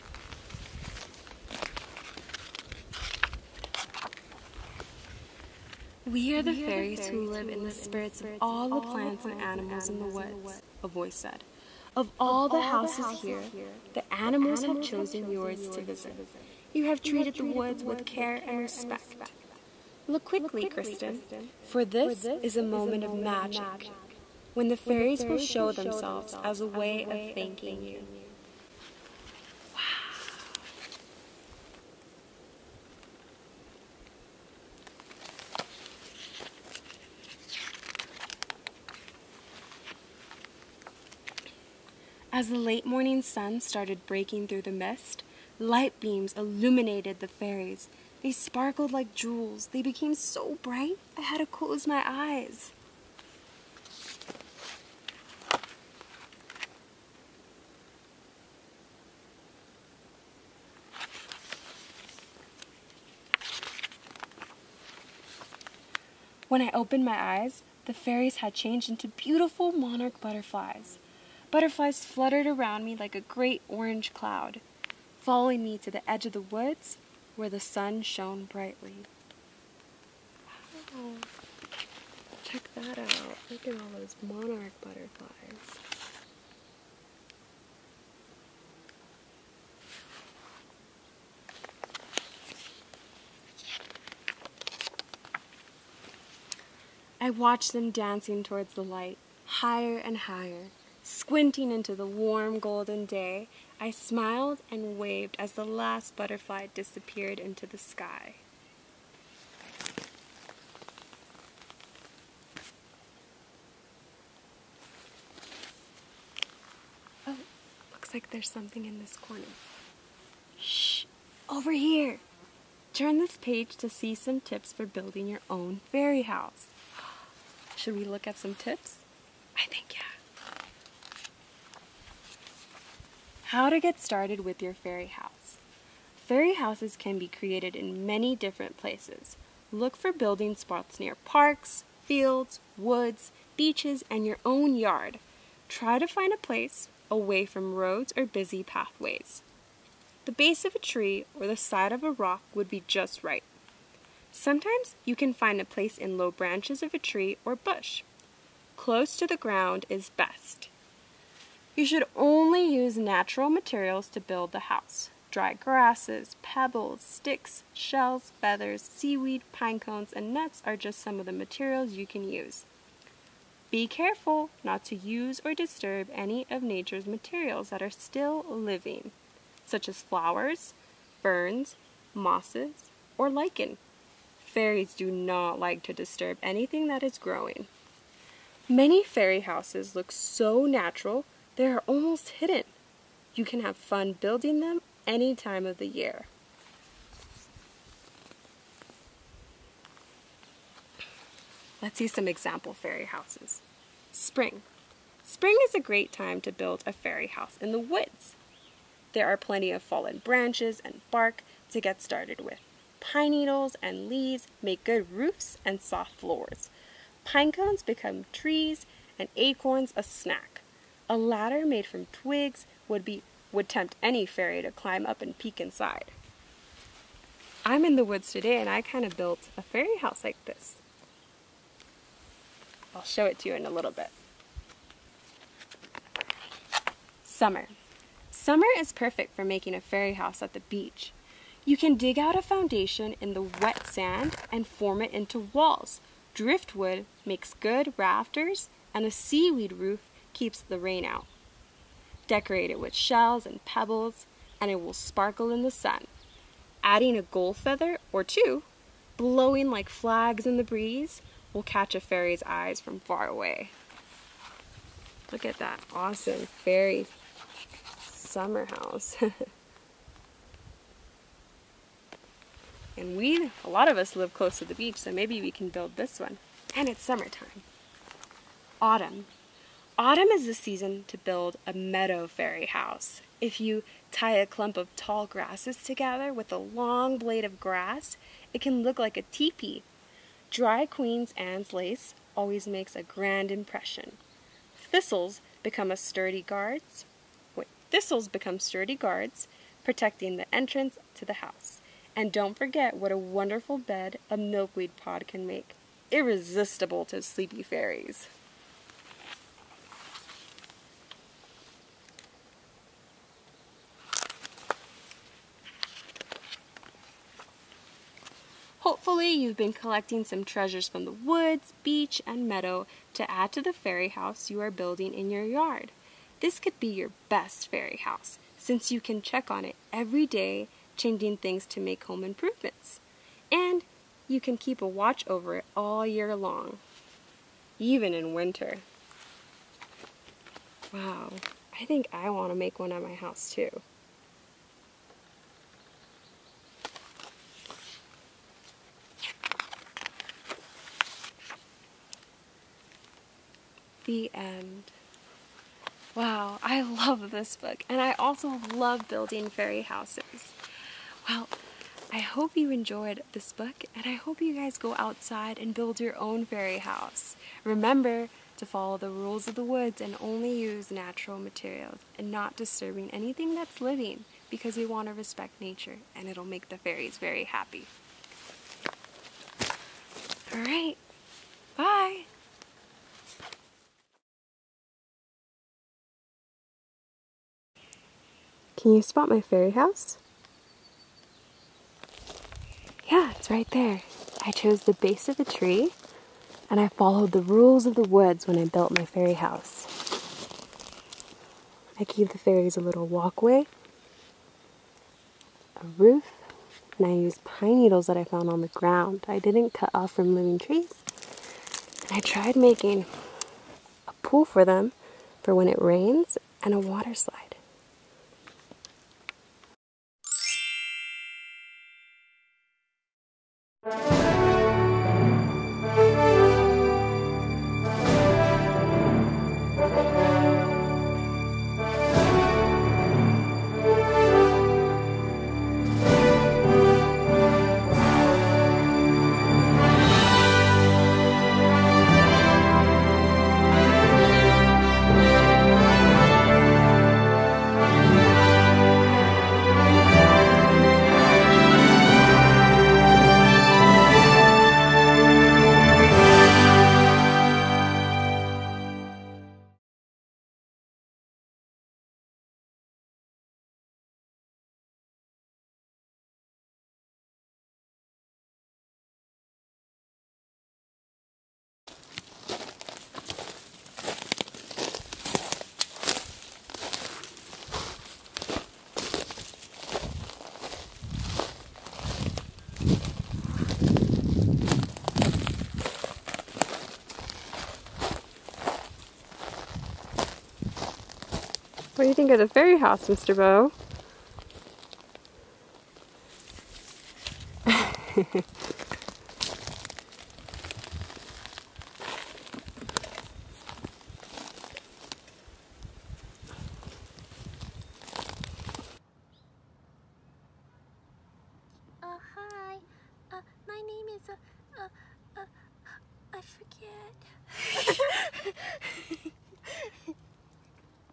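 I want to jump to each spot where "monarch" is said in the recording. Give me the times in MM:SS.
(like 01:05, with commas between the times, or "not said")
01:09, 01:24.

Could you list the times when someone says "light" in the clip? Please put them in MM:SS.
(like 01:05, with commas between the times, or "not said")
00:45, 01:38.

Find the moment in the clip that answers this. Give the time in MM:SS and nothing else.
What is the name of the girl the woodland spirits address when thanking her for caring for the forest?
00:20.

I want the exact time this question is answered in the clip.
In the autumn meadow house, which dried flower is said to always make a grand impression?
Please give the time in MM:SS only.
04:50.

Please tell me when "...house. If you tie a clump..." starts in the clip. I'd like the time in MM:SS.
04:42.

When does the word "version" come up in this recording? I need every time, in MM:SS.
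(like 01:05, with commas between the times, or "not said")
not said.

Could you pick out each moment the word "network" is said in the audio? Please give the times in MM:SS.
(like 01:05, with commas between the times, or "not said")
not said.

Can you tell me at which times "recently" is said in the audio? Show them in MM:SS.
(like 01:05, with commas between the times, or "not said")
not said.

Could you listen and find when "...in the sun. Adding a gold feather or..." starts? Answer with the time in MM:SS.
04:15.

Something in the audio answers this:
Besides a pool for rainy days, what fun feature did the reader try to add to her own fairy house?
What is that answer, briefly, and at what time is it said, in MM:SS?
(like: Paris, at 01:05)
a water slide, at 06:56.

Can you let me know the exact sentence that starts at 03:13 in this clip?
You can have fun building them any time of the year.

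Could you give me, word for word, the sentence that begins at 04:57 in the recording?
Wait, thistles become sturdy guards, protecting the entrance to the house.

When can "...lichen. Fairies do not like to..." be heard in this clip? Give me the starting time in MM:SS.
03:03.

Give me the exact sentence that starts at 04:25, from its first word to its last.
Look at that awesome fairy summer house.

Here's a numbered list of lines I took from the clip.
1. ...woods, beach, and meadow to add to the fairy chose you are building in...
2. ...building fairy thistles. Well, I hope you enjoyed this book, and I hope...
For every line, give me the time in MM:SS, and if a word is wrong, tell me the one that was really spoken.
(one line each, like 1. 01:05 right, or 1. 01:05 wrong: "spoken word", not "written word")
1. 05:21 wrong: "house", not "chose"
2. 05:59 wrong: "houses", not "thistles".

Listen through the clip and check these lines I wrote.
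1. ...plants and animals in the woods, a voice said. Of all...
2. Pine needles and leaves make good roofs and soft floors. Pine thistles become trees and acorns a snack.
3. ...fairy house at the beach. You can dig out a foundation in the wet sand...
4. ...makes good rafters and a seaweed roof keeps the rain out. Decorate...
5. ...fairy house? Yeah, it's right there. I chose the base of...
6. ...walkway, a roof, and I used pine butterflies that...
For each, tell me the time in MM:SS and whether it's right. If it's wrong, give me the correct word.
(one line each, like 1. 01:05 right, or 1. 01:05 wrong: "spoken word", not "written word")
1. 00:08 right
2. 03:32 wrong: "cones", not "thistles"
3. 03:59 right
4. 04:07 right
5. 06:29 right
6. 06:43 wrong: "needles", not "butterflies".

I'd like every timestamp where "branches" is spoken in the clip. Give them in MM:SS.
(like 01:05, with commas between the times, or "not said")
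02:36, 03:30.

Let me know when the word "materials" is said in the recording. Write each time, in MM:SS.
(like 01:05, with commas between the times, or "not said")
02:43, 02:51, 02:57, 06:11.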